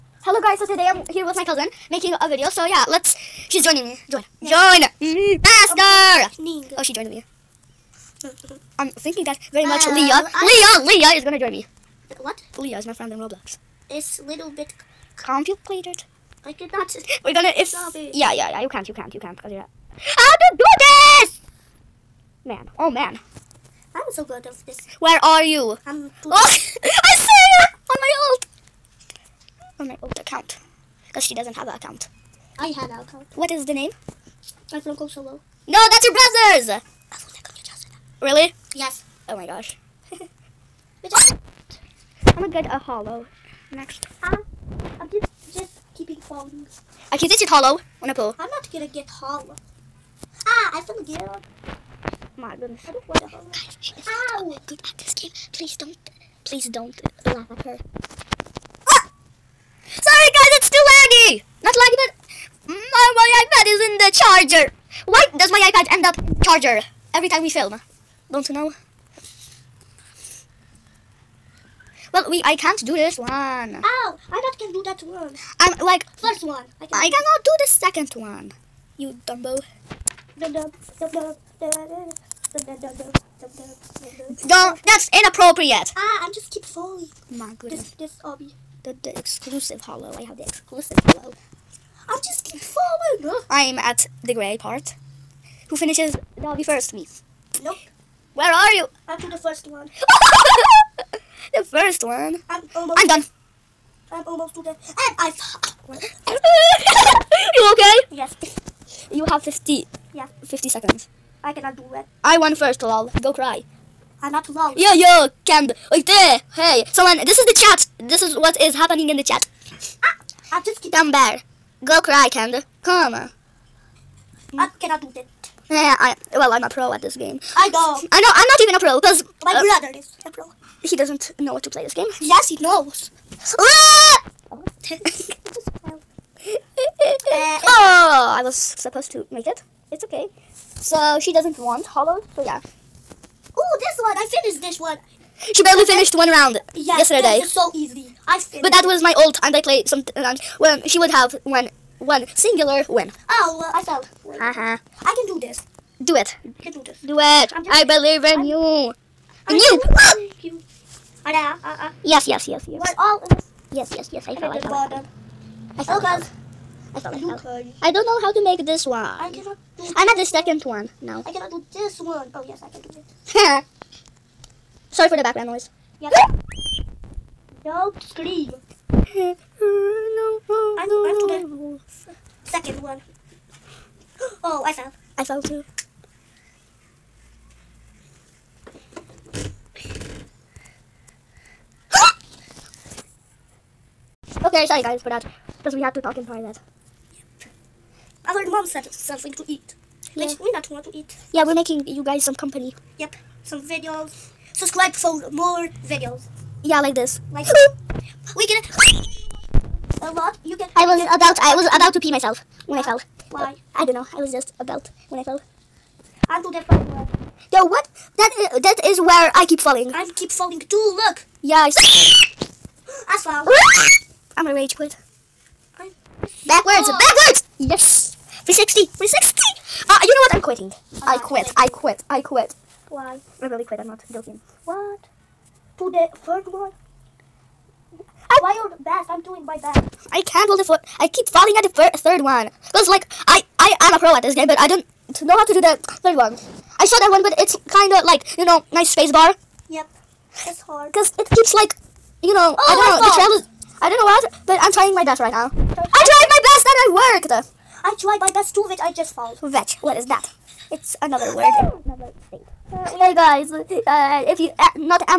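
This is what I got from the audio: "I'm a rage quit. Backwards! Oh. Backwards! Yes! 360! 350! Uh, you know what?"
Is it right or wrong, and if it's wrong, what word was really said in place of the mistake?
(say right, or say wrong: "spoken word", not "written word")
wrong: "360", not "350".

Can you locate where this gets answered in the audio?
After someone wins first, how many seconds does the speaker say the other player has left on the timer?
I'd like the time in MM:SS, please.
01:50.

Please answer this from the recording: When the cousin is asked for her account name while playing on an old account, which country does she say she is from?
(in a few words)
Kosovo.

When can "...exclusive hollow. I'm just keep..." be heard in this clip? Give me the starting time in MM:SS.
01:30.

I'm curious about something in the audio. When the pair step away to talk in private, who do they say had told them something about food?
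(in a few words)
Our mom.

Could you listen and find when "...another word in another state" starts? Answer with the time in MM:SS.
04:21.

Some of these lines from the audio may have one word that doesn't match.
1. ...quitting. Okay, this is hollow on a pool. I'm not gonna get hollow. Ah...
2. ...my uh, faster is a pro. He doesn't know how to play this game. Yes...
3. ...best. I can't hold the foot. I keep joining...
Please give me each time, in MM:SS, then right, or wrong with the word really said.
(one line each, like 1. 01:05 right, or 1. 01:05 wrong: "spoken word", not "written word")
1. 00:46 wrong: "falling", not "quitting"
2. 02:09 wrong: "brother", not "faster"
3. 03:59 wrong: "falling", not "joining".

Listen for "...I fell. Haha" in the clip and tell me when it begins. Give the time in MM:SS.
02:33.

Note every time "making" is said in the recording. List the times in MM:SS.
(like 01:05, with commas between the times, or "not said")
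00:01, 03:21.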